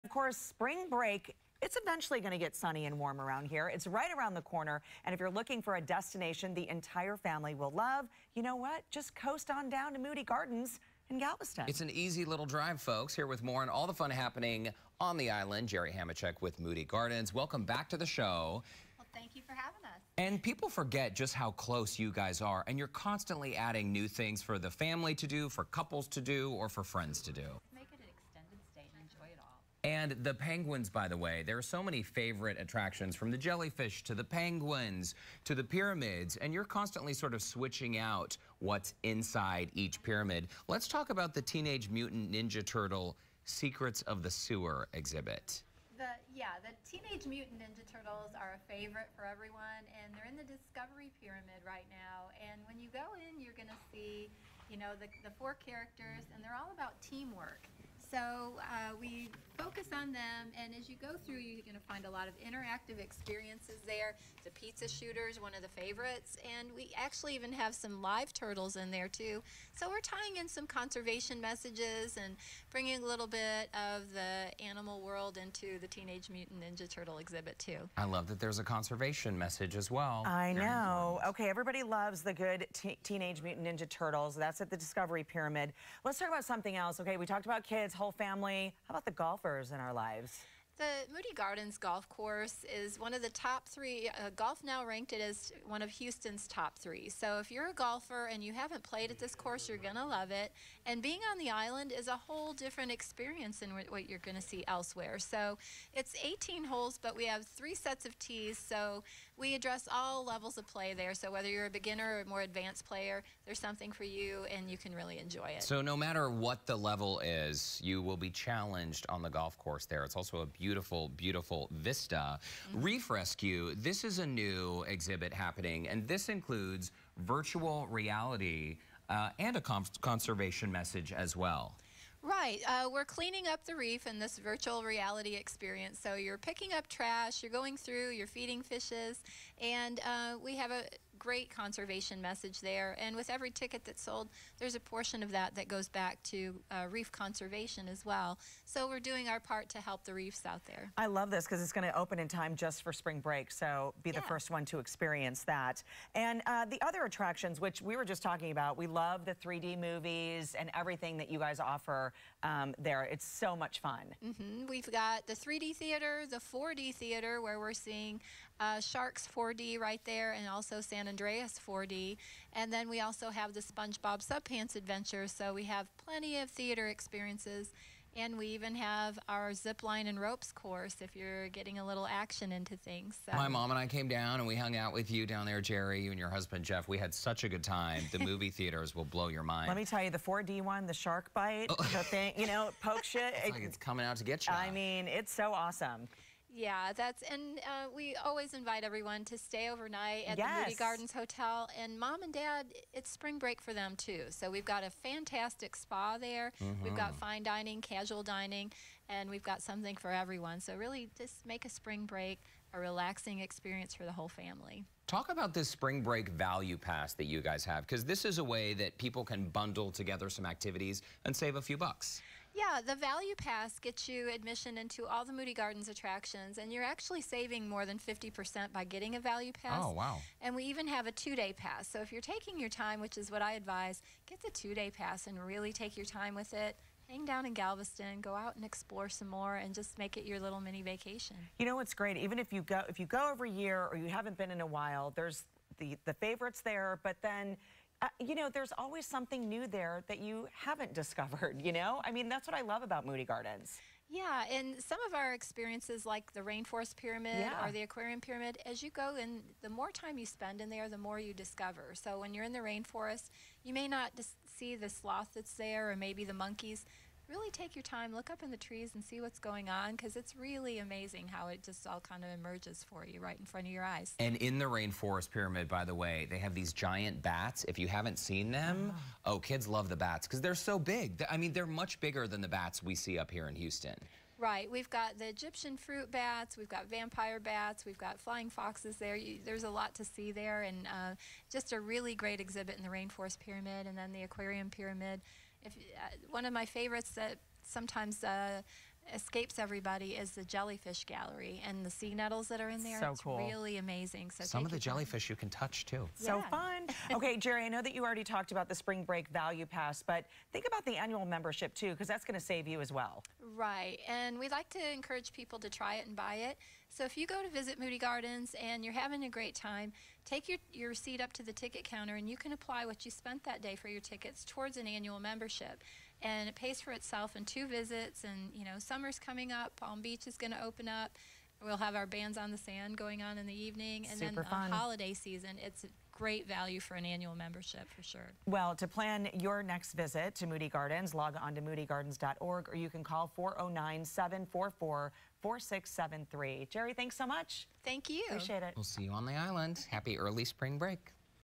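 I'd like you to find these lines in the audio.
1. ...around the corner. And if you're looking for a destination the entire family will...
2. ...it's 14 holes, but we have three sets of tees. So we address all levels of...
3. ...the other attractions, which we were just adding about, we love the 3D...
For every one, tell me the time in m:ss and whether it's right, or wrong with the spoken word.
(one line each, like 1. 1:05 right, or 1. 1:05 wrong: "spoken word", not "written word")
1. 0:04 right
2. 1:45 wrong: "18", not "14"
3. 2:36 wrong: "talking", not "adding".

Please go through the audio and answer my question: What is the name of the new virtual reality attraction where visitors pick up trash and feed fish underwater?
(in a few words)
Reef Rescue.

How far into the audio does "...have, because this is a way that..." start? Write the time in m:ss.
3:37.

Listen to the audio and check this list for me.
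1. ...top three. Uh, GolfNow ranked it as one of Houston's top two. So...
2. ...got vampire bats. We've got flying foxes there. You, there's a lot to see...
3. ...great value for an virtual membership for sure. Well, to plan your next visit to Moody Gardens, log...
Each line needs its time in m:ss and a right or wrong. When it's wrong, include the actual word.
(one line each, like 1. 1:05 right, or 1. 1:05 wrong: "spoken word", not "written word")
1. 1:33 wrong: "three", not "two"
2. 4:46 right
3. 5:36 wrong: "annual", not "virtual".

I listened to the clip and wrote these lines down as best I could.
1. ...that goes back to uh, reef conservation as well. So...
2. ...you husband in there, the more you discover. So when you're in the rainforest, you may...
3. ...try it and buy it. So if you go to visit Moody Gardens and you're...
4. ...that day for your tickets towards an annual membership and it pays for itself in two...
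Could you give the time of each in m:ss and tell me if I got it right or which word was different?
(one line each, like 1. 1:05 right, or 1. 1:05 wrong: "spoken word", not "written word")
1. 2:25 right
2. 4:20 wrong: "spend", not "husband"
3. 5:15 right
4. 5:23 right.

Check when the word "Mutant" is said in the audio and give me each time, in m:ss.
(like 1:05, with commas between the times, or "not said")
0:41, 0:47, 1:16, 1:23.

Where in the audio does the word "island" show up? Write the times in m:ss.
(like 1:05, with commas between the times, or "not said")
0:15, 1:41, 5:49.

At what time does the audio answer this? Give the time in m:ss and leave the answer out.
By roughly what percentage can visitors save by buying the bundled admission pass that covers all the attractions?
3:47.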